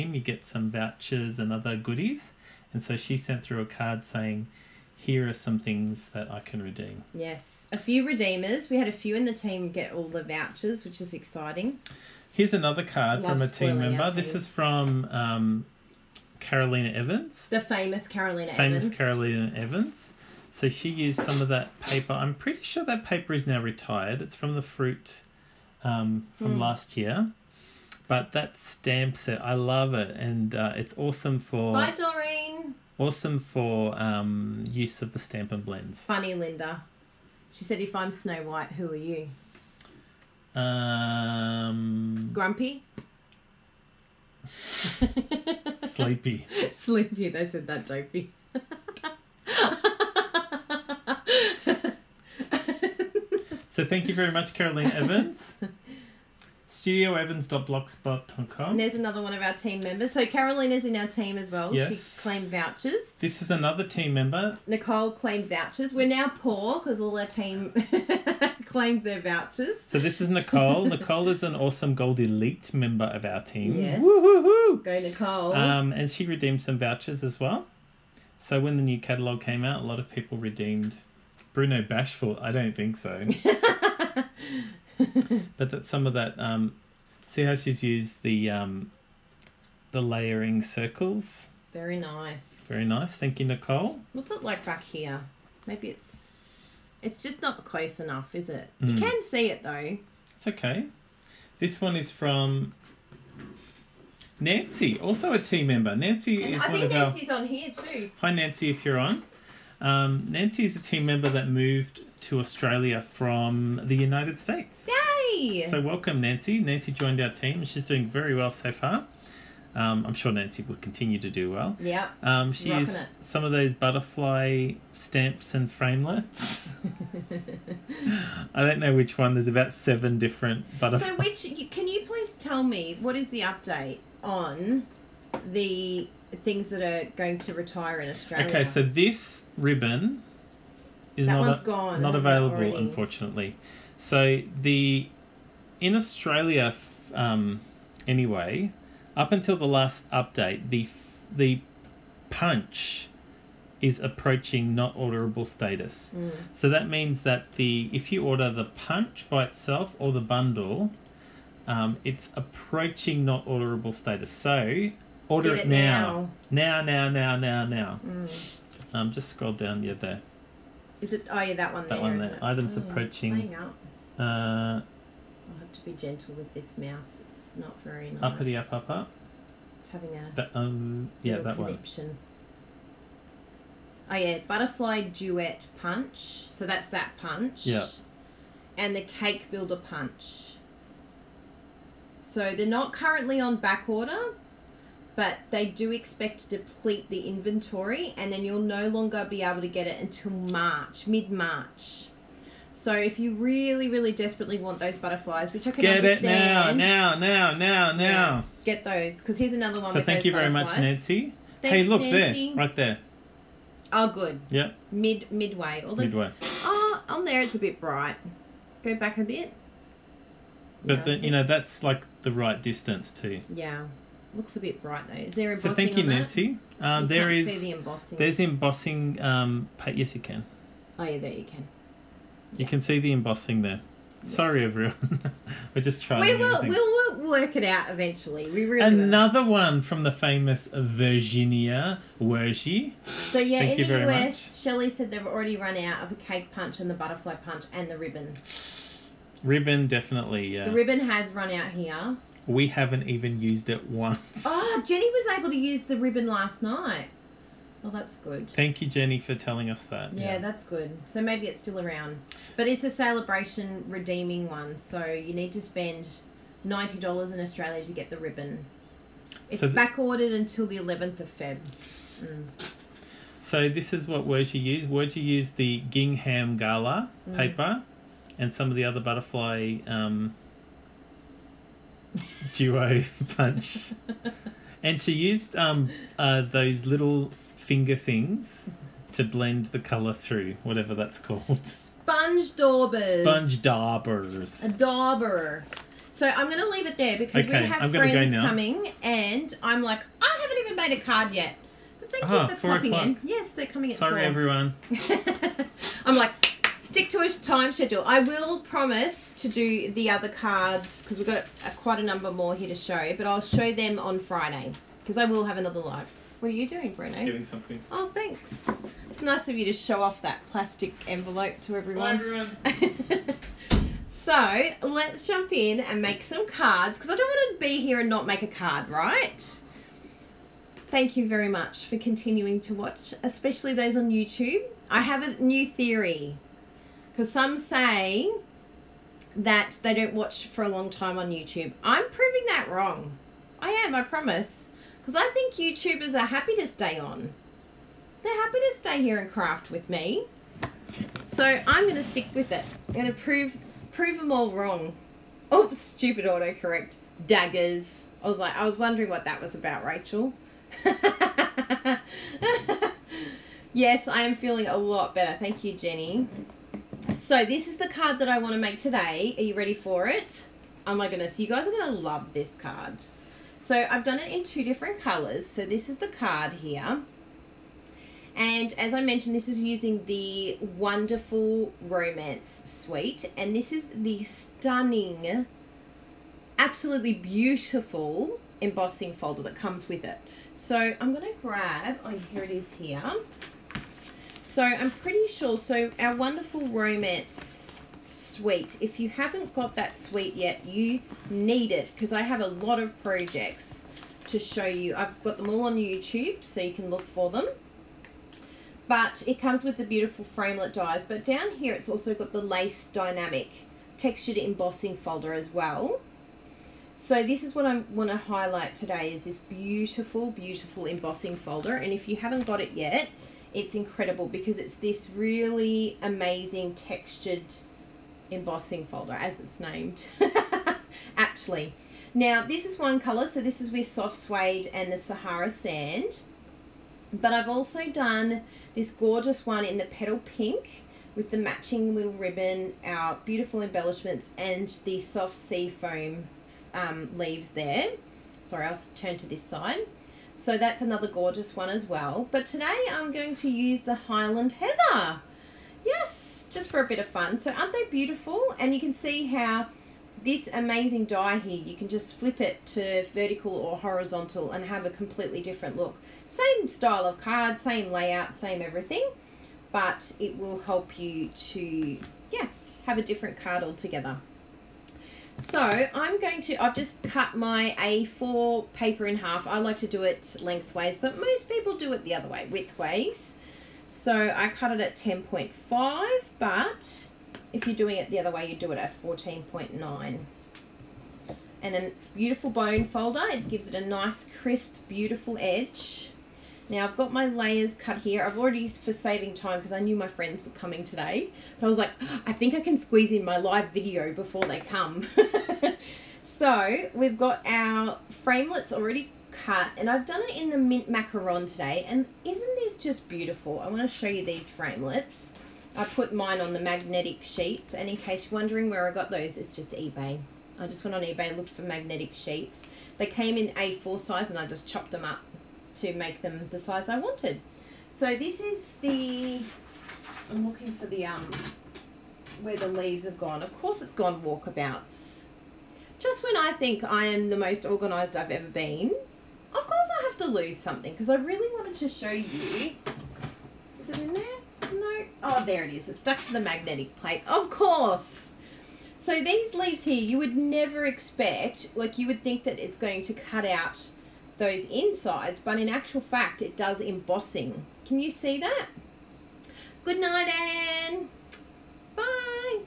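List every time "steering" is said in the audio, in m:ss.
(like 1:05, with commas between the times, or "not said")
not said.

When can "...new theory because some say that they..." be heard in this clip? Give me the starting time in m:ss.
5:35.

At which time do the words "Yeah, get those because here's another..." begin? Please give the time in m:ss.
3:28.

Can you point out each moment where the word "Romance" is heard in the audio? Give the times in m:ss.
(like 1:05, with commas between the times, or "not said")
6:21, 6:36.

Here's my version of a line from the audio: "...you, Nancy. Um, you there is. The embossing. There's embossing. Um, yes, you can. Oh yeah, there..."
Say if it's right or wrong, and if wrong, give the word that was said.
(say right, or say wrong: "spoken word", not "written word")
right.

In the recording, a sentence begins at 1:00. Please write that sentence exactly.
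So Caroline is in our team as well.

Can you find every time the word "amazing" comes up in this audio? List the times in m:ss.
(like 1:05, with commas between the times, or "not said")
7:06, 7:40.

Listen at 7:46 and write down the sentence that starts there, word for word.
Same style of card, same layout, same everything, but it will help you to, yeah, have a different card altogether.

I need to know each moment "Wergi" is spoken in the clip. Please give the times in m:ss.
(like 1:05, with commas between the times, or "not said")
4:02.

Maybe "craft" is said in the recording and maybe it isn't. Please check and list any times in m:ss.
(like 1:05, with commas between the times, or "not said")
5:49.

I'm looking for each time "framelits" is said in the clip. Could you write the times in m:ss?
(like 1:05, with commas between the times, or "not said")
2:05, 6:50, 8:28, 8:34.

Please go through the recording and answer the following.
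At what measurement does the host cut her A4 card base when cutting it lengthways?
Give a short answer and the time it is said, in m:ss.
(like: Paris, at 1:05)
10.5, at 8:04.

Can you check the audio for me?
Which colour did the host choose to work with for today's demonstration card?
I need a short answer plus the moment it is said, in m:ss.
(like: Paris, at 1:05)
Highland Heather, at 7:33.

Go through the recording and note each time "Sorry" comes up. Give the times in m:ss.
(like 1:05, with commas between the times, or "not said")
3:54, 5:03, 7:28.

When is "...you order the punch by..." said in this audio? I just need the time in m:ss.
2:38.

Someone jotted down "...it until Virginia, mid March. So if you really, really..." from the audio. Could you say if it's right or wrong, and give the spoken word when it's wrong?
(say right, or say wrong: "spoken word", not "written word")
wrong: "March", not "Virginia".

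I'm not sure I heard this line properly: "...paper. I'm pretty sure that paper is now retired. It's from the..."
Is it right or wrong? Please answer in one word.
right.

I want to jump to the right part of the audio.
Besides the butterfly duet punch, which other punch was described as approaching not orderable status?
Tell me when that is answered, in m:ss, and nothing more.
3:09.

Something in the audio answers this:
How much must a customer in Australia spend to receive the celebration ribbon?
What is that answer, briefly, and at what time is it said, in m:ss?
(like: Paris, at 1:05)
$90, at 4:26.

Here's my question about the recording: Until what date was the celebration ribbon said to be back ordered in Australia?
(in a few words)
11th of Feb.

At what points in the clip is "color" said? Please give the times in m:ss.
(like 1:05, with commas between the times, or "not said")
4:49, 6:15, 7:12.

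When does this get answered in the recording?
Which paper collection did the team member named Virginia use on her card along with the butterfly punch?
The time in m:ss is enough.
4:35.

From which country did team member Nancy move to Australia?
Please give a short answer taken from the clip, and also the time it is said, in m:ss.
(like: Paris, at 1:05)
United States, at 1:53.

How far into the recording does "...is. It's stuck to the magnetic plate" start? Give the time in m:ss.
9:05.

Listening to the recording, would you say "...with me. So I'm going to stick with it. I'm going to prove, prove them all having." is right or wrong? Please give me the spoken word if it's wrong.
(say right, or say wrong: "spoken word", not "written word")
wrong: "wrong", not "having".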